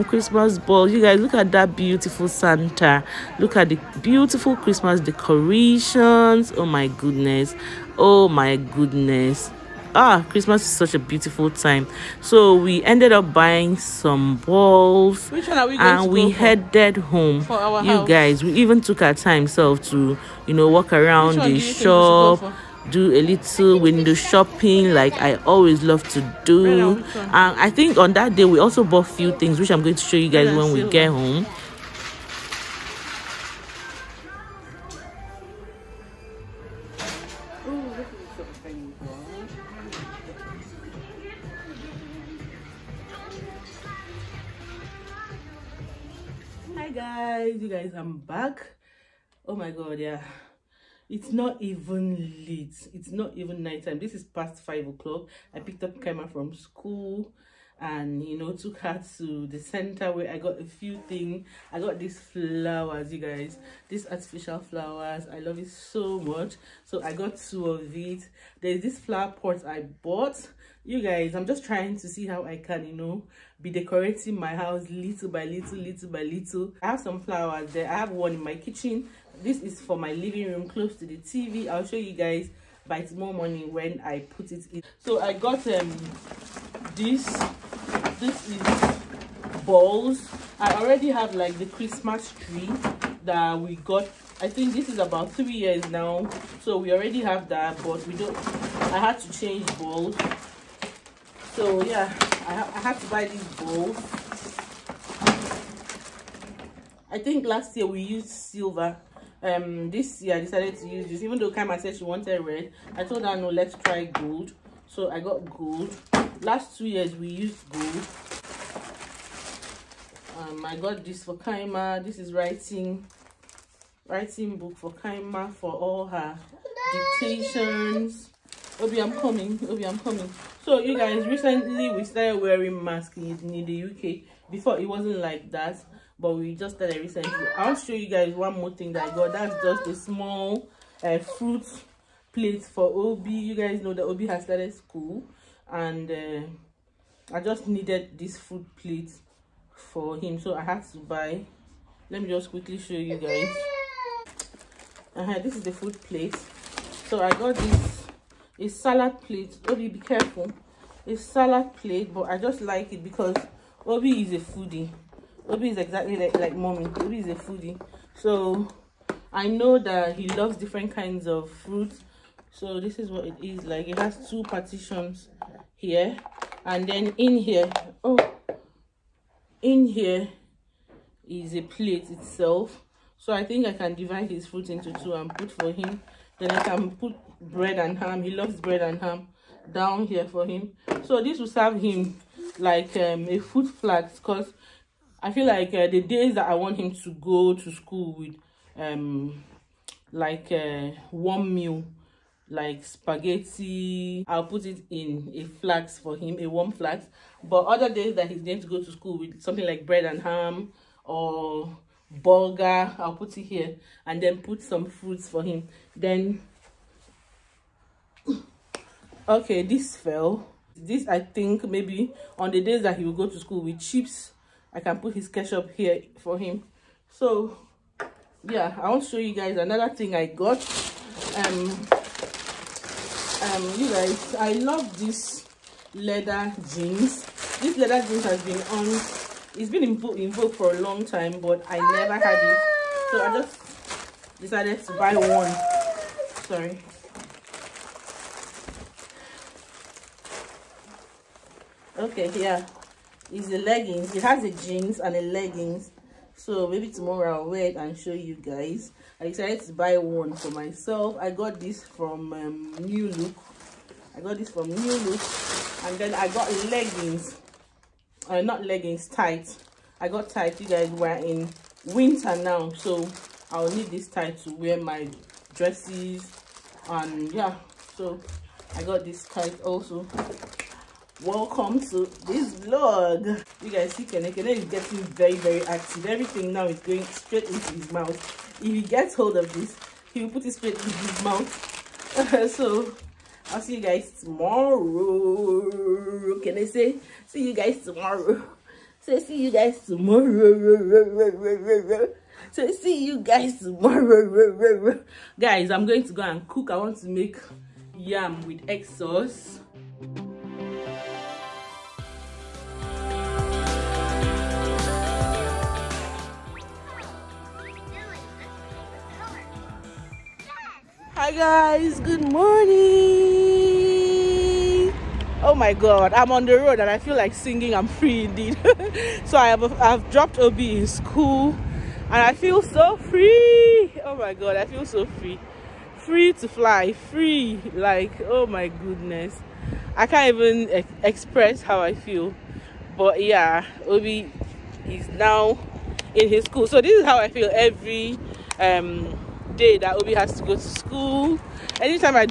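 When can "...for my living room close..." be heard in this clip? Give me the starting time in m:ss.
1:19.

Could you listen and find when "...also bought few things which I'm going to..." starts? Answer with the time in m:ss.
0:28.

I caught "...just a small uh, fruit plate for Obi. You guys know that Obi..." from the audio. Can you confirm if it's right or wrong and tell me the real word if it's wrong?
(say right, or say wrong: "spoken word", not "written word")
right.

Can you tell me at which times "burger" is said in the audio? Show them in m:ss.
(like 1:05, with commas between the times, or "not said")
3:32.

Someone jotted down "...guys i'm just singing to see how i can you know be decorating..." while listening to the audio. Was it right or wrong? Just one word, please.
wrong.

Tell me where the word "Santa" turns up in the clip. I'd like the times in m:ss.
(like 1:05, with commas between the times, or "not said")
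0:02.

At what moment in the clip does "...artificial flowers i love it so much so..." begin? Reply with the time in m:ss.
1:04.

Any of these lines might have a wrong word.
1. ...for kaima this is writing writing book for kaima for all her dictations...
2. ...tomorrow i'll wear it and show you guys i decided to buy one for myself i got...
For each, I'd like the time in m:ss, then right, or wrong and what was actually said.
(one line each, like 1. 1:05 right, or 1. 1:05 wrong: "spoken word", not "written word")
1. 2:01 right
2. 4:16 right.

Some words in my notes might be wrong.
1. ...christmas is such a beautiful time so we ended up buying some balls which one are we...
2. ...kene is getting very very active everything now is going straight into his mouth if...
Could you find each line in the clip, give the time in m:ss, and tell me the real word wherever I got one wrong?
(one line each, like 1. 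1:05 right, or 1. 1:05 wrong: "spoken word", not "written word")
1. 0:10 right
2. 4:44 right.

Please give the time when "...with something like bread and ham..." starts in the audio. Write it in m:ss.
3:29.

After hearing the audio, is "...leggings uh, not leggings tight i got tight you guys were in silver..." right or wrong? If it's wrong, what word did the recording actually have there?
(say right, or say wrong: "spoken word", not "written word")
wrong: "winter", not "silver".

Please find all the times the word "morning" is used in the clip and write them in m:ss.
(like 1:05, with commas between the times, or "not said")
1:23, 5:22.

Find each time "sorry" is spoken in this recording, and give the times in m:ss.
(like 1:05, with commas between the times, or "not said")
4:06.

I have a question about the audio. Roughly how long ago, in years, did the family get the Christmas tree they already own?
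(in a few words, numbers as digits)
3 years.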